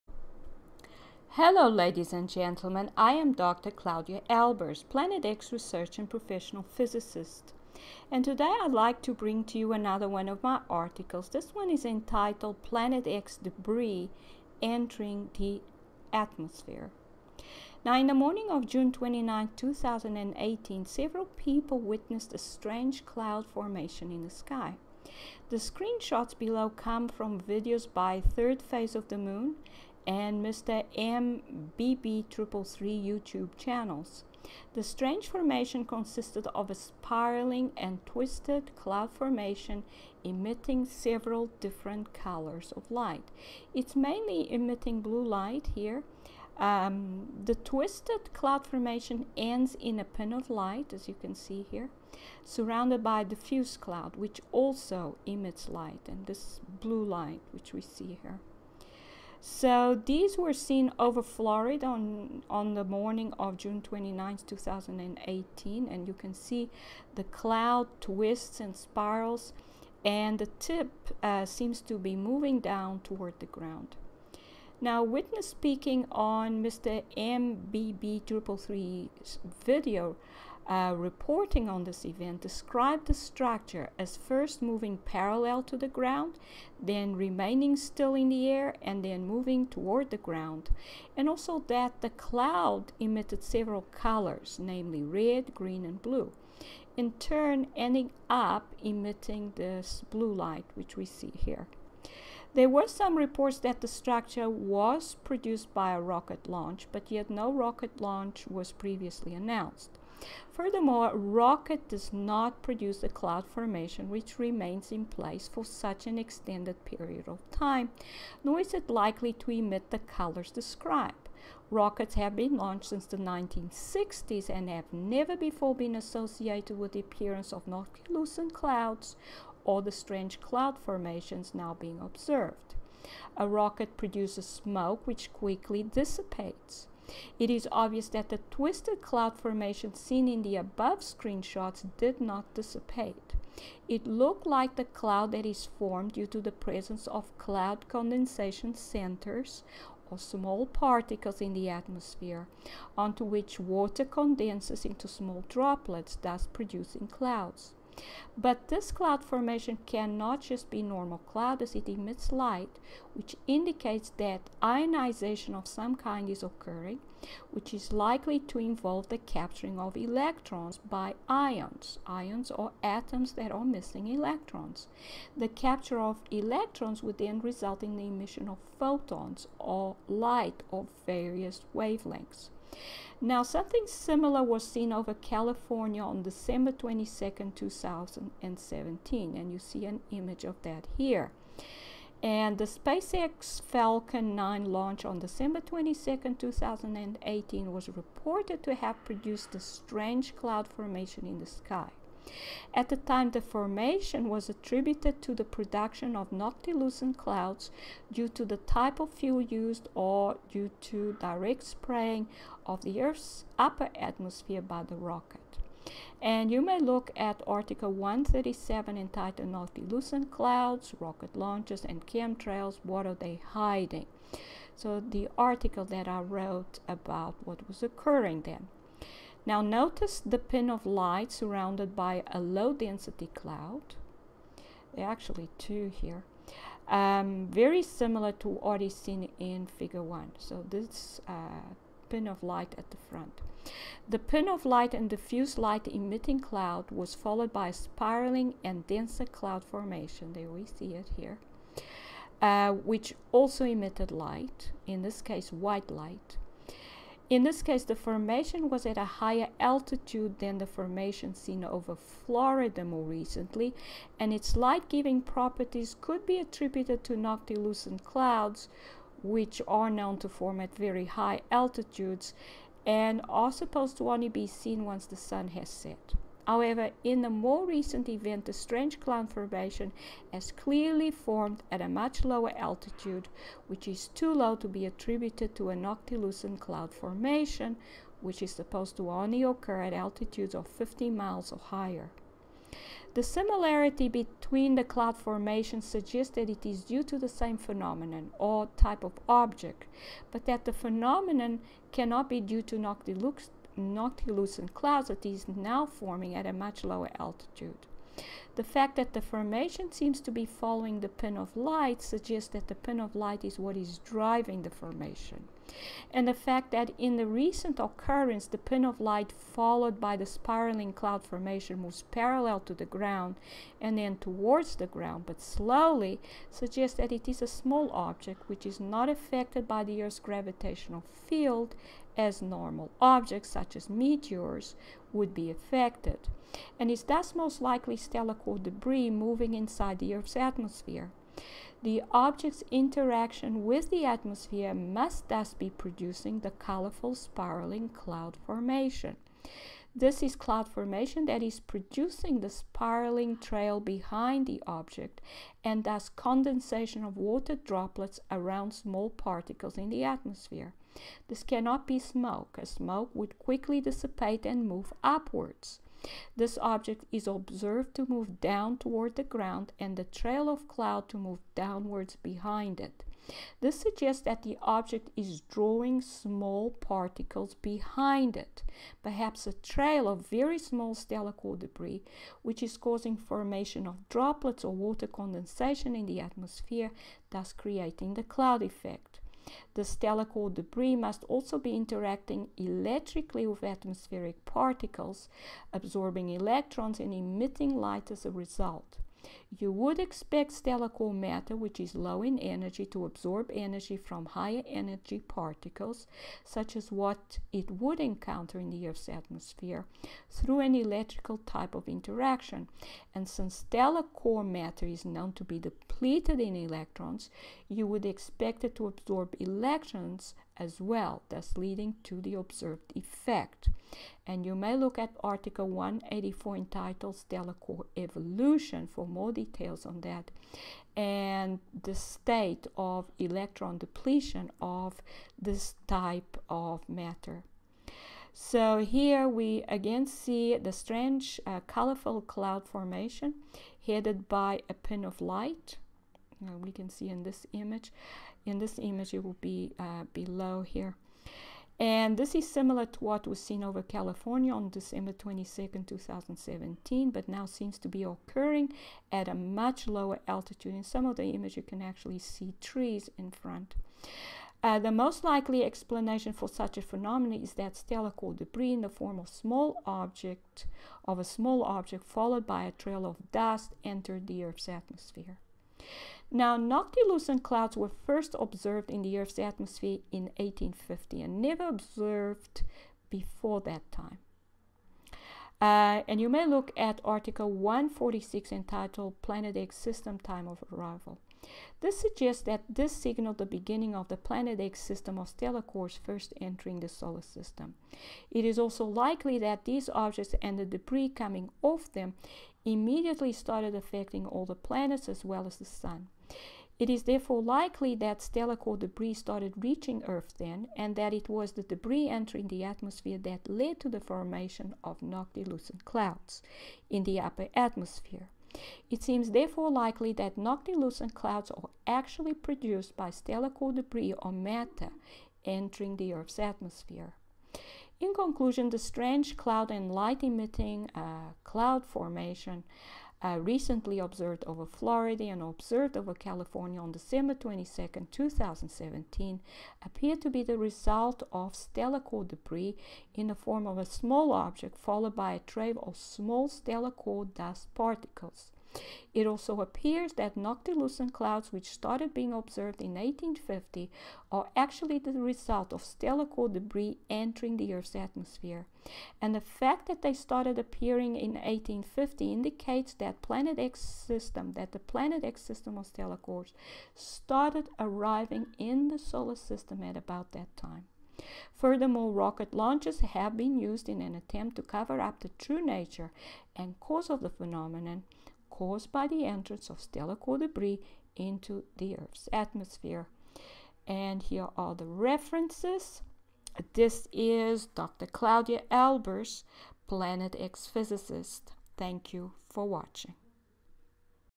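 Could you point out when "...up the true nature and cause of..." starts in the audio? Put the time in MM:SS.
09:35.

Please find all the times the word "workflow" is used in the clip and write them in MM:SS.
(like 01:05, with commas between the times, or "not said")
not said.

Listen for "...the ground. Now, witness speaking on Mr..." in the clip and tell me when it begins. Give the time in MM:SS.
01:13.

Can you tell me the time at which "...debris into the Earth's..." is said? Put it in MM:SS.
09:40.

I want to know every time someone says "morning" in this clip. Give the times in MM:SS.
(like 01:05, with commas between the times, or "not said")
00:18, 01:02.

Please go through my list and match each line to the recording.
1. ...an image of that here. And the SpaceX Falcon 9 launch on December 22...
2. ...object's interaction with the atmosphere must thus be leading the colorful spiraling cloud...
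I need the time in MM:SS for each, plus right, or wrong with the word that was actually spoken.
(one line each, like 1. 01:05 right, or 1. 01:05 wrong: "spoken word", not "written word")
1. 03:09 right
2. 05:42 wrong: "producing", not "leading".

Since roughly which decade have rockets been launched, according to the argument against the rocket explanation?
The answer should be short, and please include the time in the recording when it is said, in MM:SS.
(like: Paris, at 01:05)
1960s, at 02:03.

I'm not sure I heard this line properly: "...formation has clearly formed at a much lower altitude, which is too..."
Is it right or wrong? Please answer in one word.
right.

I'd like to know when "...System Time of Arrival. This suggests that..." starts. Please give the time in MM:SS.
08:09.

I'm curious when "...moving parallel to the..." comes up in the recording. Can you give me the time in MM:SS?
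01:24.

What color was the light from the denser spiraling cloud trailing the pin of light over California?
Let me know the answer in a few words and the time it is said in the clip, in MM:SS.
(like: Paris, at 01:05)
White, at 04:15.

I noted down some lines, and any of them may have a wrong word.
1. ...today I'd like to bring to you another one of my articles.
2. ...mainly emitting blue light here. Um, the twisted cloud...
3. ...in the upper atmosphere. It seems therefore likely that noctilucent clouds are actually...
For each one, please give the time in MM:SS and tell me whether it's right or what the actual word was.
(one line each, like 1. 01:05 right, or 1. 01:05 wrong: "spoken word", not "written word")
1. 00:08 right
2. 00:43 right
3. 08:36 right.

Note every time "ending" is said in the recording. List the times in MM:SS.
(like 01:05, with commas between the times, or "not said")
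01:37.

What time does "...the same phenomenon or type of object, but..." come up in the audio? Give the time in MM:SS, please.
04:57.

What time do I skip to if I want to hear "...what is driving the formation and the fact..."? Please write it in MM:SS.
05:13.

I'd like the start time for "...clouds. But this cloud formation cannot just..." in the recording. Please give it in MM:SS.
02:37.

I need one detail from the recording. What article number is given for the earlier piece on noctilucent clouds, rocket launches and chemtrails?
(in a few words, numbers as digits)
137.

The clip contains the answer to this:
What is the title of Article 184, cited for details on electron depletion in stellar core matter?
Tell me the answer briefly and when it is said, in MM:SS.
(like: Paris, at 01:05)
Stellar Core Evolution, at 07:07.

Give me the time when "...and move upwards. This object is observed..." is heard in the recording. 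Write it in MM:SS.
06:04.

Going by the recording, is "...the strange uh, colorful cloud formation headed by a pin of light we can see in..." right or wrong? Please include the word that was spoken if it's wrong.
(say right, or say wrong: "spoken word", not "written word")
right.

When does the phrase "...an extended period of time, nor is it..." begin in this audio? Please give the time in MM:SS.
01:56.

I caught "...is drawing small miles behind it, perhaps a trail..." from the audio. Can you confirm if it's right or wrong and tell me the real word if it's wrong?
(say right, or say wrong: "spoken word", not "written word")
wrong: "particles", not "miles".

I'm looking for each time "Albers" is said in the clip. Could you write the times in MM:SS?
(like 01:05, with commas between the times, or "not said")
00:04, 09:48.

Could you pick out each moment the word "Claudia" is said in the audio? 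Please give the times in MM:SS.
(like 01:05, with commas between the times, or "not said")
00:03, 09:48.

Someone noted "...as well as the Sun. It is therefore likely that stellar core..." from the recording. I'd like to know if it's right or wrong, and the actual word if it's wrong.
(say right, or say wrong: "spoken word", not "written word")
right.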